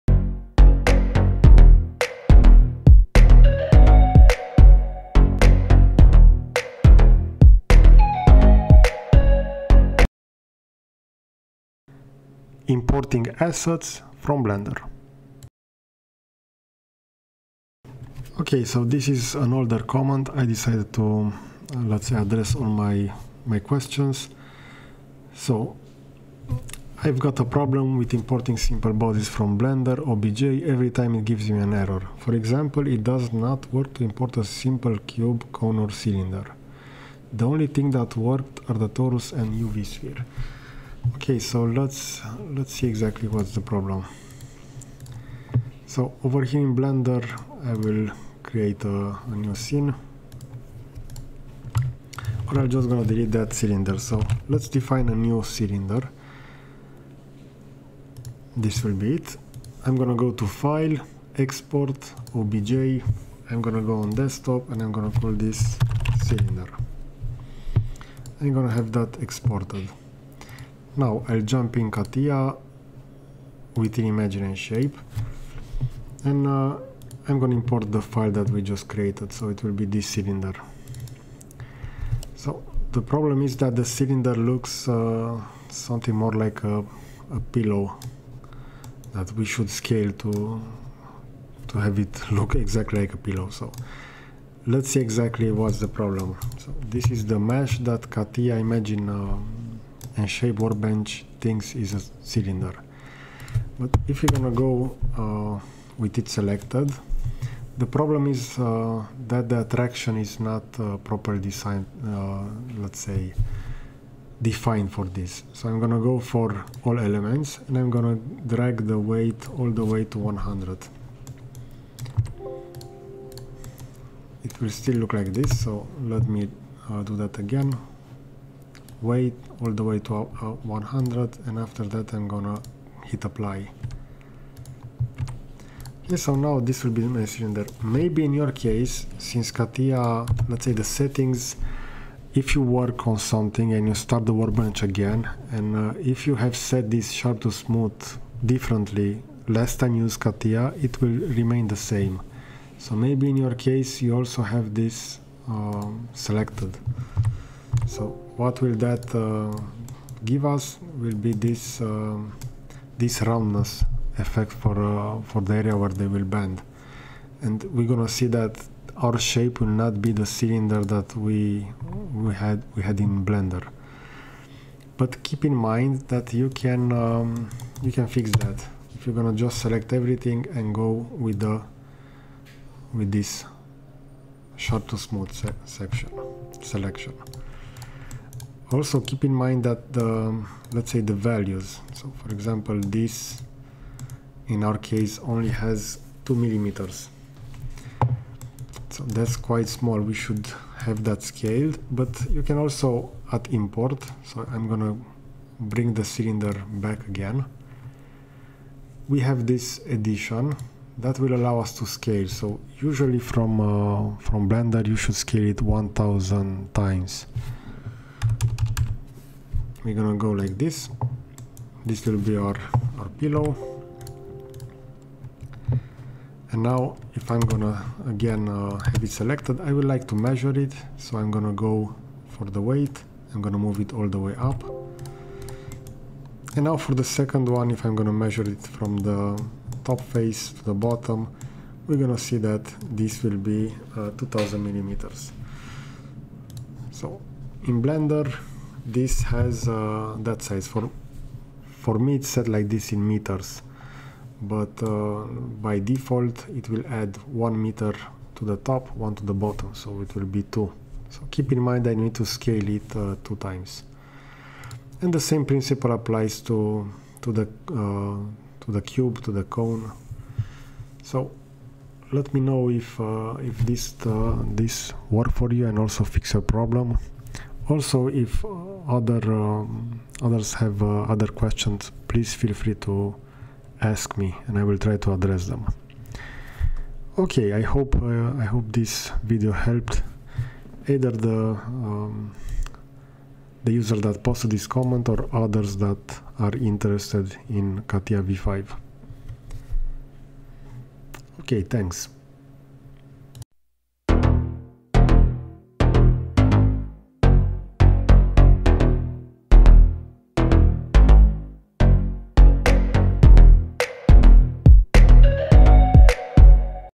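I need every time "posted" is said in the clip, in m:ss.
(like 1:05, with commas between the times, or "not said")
4:54.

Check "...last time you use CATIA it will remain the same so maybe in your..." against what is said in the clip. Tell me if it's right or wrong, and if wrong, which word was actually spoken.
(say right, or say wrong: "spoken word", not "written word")
right.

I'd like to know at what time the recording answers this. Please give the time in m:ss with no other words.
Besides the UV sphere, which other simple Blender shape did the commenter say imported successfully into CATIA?
0:38.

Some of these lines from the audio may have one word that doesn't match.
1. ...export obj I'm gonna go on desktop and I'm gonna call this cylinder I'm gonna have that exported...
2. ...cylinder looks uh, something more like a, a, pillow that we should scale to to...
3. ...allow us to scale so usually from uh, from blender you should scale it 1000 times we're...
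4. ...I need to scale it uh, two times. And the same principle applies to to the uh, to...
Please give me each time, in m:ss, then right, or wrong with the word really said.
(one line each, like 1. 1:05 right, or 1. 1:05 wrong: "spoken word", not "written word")
1. 1:01 right
2. 1:23 right
3. 3:31 right
4. 4:21 right.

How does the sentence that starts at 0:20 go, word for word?
I decided to, uh, let's say, address all my, my questions.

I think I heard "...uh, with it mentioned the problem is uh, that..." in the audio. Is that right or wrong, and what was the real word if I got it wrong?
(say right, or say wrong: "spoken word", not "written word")
wrong: "selected", not "mentioned".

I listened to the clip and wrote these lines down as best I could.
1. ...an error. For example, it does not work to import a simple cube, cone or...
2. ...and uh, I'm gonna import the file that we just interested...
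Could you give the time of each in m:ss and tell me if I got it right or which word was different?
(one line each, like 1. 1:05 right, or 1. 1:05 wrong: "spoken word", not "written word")
1. 0:31 right
2. 1:16 wrong: "created", not "interested".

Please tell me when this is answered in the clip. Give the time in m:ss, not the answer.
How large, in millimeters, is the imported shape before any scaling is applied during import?
3:16.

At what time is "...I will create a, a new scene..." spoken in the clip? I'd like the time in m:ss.
0:47.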